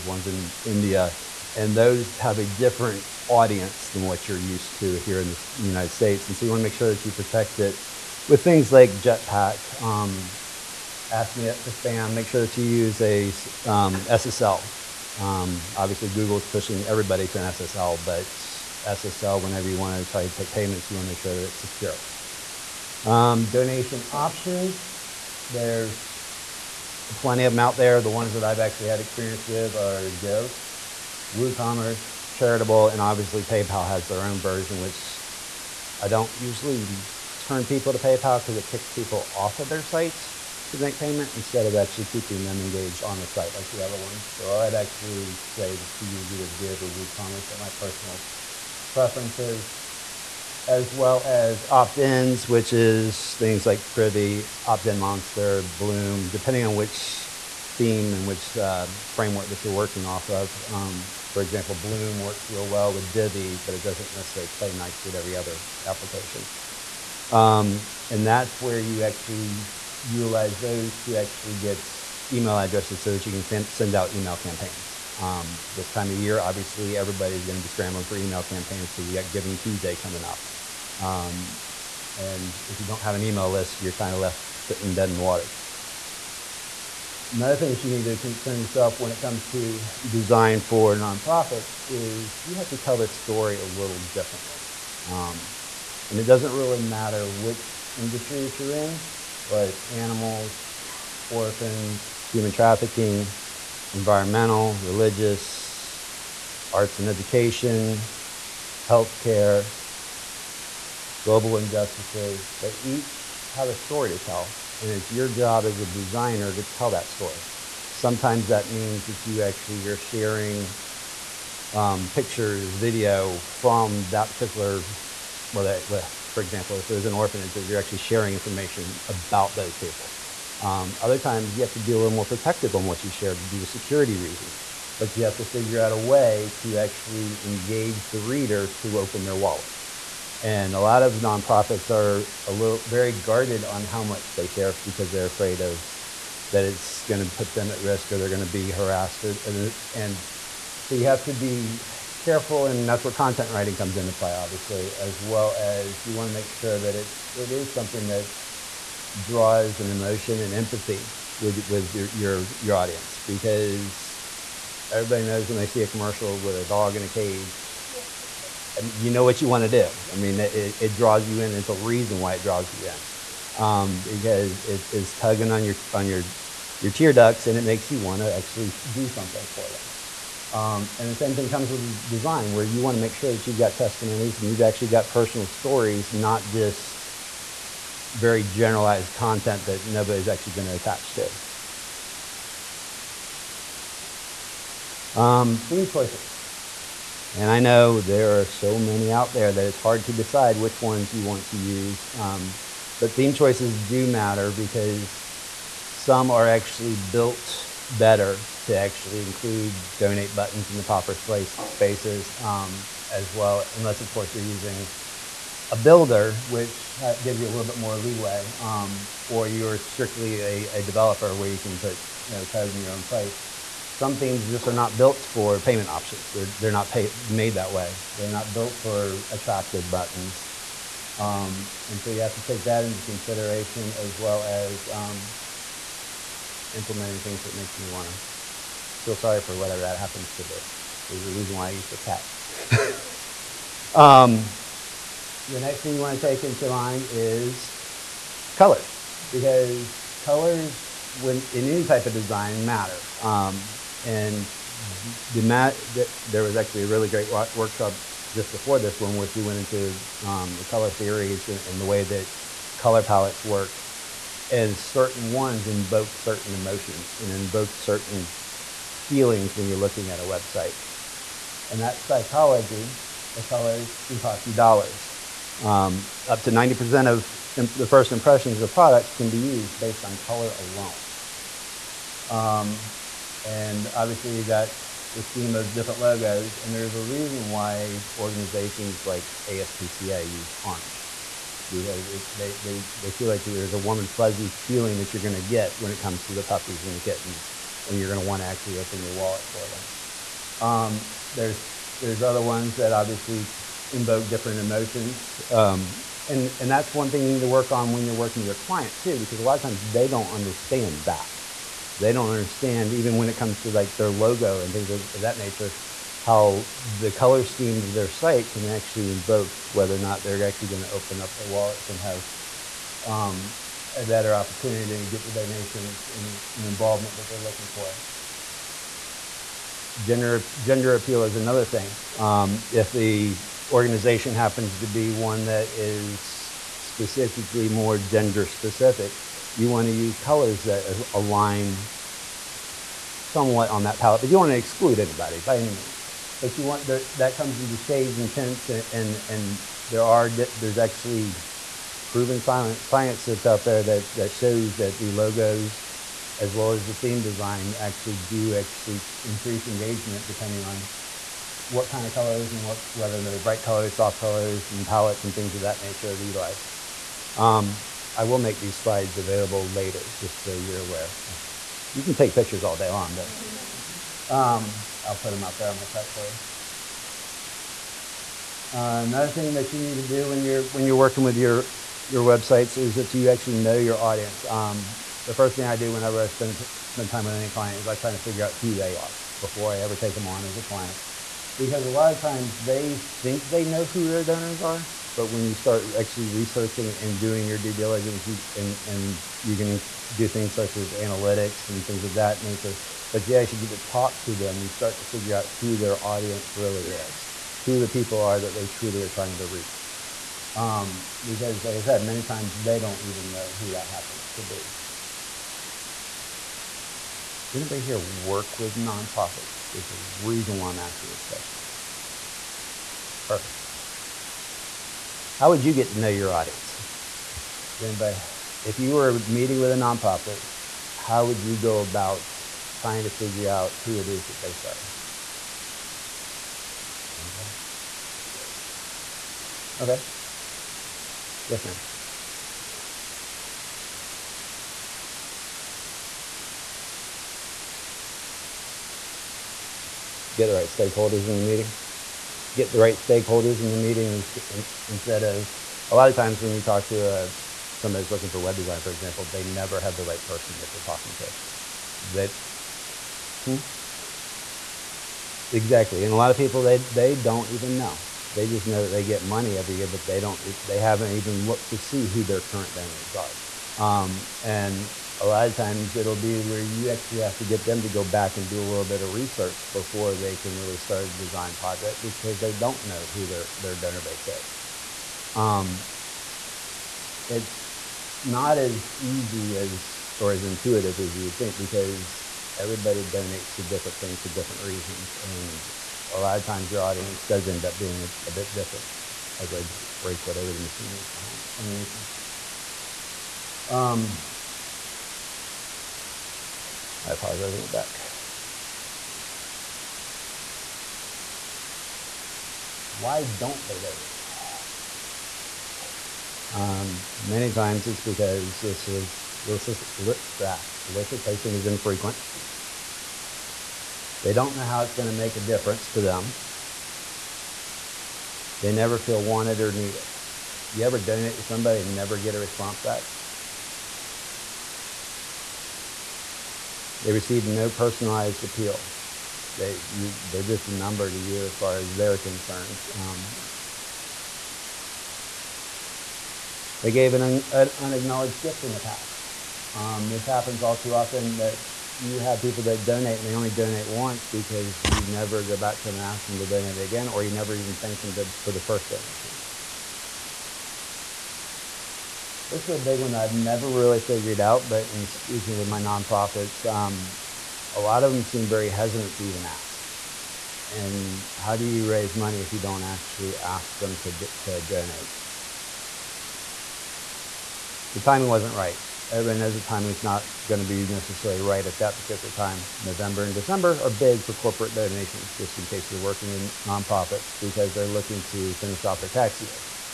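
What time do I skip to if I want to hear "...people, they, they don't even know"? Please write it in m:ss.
7:46.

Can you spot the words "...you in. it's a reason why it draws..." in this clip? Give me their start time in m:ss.
2:51.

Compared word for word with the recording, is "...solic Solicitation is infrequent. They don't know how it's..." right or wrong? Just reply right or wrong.
right.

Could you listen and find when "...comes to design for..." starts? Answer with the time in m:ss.
1:29.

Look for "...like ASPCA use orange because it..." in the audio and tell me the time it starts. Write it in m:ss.
4:49.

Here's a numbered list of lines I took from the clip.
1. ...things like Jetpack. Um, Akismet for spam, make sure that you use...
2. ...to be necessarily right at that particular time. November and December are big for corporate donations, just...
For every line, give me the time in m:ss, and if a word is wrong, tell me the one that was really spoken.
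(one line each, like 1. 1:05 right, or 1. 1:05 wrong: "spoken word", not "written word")
1. 0:08 right
2. 9:40 right.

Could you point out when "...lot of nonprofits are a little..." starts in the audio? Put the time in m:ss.
2:20.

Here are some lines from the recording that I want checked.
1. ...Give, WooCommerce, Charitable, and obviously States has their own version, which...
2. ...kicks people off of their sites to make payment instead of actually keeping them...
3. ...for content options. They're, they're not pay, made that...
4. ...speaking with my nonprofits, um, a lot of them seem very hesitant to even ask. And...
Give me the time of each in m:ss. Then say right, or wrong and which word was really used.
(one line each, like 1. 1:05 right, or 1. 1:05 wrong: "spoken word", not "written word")
1. 0:30 wrong: "PayPal", not "States"
2. 0:38 right
3. 3:45 wrong: "payment", not "content"
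4. 9:25 right.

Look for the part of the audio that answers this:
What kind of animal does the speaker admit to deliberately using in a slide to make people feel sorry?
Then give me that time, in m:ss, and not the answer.
4:01.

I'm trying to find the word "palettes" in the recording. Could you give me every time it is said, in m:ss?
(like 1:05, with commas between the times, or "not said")
4:23, 5:43, 6:04.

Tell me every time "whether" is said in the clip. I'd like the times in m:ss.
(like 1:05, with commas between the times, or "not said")
5:19, 6:02.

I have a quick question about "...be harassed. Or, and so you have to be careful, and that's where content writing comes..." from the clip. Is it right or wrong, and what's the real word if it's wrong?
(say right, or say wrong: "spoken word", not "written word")
right.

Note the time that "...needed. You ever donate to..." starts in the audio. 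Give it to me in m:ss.
8:49.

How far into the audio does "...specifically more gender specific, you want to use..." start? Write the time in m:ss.
5:36.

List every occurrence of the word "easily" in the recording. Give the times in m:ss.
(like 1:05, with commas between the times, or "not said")
not said.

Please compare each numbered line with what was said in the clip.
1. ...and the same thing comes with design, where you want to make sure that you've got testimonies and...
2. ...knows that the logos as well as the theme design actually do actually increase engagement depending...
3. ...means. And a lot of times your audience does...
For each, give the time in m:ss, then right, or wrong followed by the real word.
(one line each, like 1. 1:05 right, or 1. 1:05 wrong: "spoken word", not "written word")
1. 3:00 right
2. 5:54 wrong: "shows", not "knows"
3. 8:14 wrong: "reasons", not "means".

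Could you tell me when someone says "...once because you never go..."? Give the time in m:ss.
9:13.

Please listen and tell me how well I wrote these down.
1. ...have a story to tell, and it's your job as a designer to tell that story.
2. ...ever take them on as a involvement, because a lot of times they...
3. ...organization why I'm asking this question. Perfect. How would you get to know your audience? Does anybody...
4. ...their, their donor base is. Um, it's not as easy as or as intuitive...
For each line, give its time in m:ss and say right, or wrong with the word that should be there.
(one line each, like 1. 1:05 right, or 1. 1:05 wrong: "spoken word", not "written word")
1. 1:53 right
2. 6:29 wrong: "client", not "involvement"
3. 7:00 wrong: "reason", not "organization"
4. 8:03 right.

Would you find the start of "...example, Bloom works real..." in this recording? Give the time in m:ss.
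1:01.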